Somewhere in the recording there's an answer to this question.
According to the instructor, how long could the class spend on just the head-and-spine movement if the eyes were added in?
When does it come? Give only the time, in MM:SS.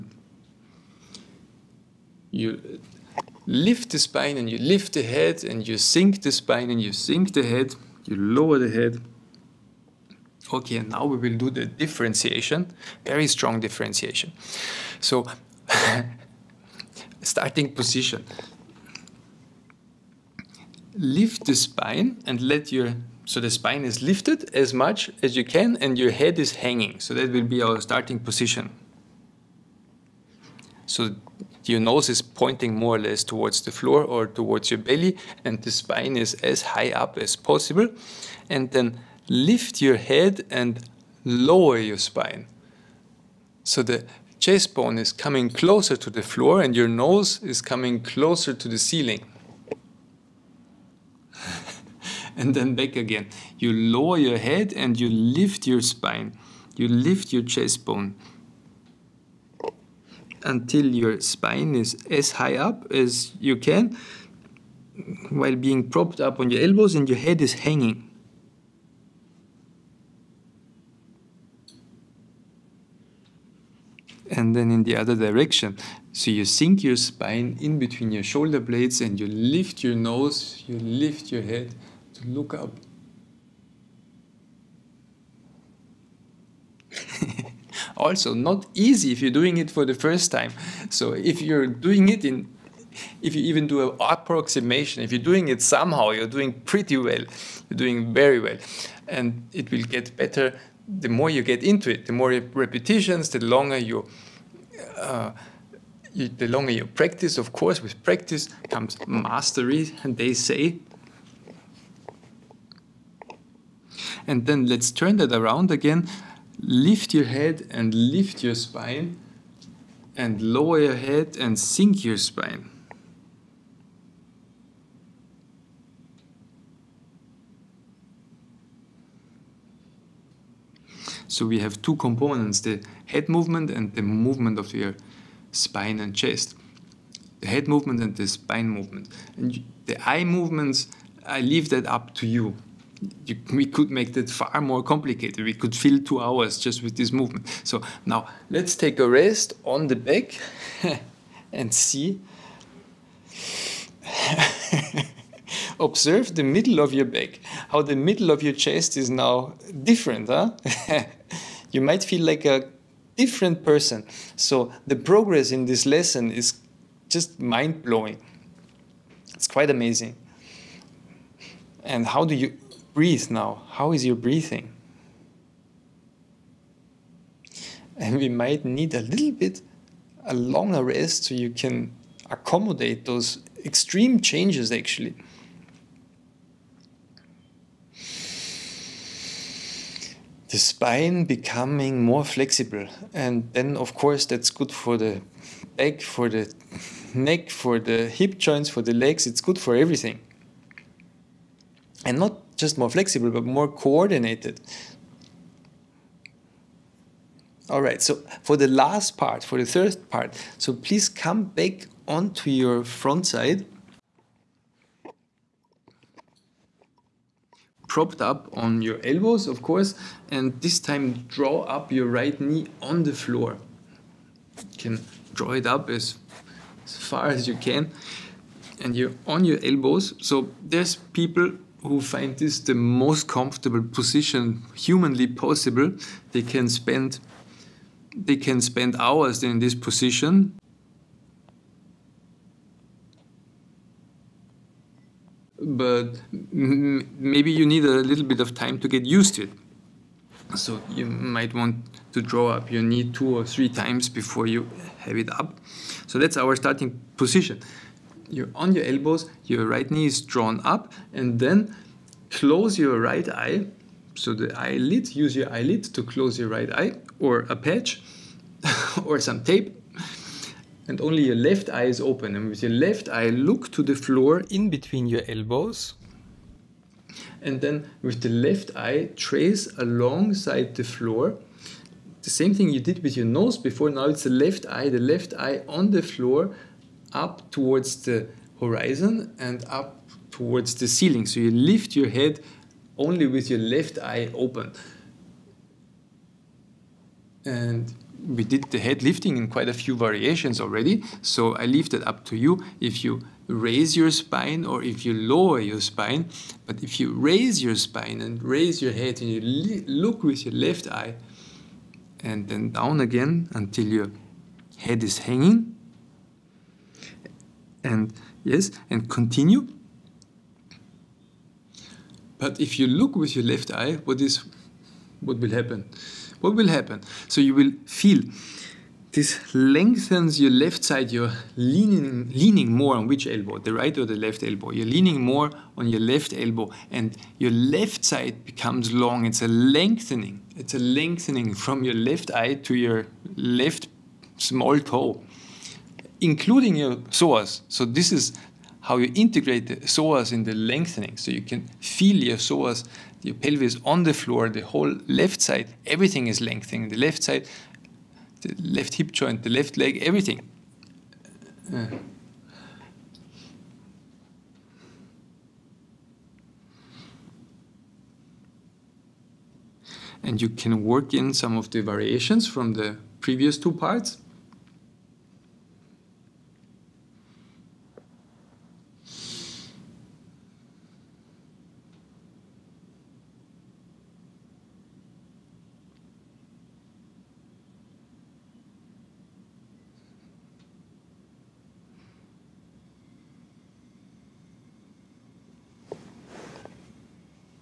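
02:25.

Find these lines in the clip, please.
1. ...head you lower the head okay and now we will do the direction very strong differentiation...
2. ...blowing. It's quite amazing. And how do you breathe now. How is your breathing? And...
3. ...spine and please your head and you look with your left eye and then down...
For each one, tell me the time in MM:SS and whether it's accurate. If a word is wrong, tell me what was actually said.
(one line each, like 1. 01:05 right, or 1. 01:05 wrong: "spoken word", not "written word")
1. 00:07 wrong: "differentiation", not "direction"
2. 02:47 right
3. 05:07 wrong: "raise", not "please".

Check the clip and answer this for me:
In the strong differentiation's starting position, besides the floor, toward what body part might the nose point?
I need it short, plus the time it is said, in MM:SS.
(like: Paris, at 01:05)
belly, at 00:34.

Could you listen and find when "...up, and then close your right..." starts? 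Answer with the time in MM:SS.
04:20.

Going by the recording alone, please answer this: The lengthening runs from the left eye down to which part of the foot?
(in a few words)
left small toe.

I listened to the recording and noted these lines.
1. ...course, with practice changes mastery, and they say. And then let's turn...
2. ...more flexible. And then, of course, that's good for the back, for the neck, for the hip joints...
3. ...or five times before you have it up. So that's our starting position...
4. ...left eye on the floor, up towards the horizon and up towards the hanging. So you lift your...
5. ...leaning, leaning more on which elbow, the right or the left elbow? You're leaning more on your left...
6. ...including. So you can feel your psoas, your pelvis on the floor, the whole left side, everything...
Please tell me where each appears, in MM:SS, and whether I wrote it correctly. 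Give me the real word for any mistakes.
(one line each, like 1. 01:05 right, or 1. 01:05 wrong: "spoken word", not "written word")
1. 01:47 wrong: "comes", not "changes"
2. 03:12 right
3. 04:13 wrong: "three", not "five"
4. 04:44 wrong: "ceiling", not "hanging"
5. 05:31 right
6. 05:50 wrong: "lengthening", not "including".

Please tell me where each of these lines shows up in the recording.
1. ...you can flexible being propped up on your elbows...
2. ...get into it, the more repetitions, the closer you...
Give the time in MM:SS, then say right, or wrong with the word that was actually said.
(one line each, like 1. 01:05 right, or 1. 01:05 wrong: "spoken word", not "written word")
1. 01:03 wrong: "while", not "flexible"
2. 01:41 wrong: "longer", not "closer".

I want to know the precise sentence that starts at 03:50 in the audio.
So there's people who find this the most comfortable position humanly possible, they can spend they can spend hours in this position.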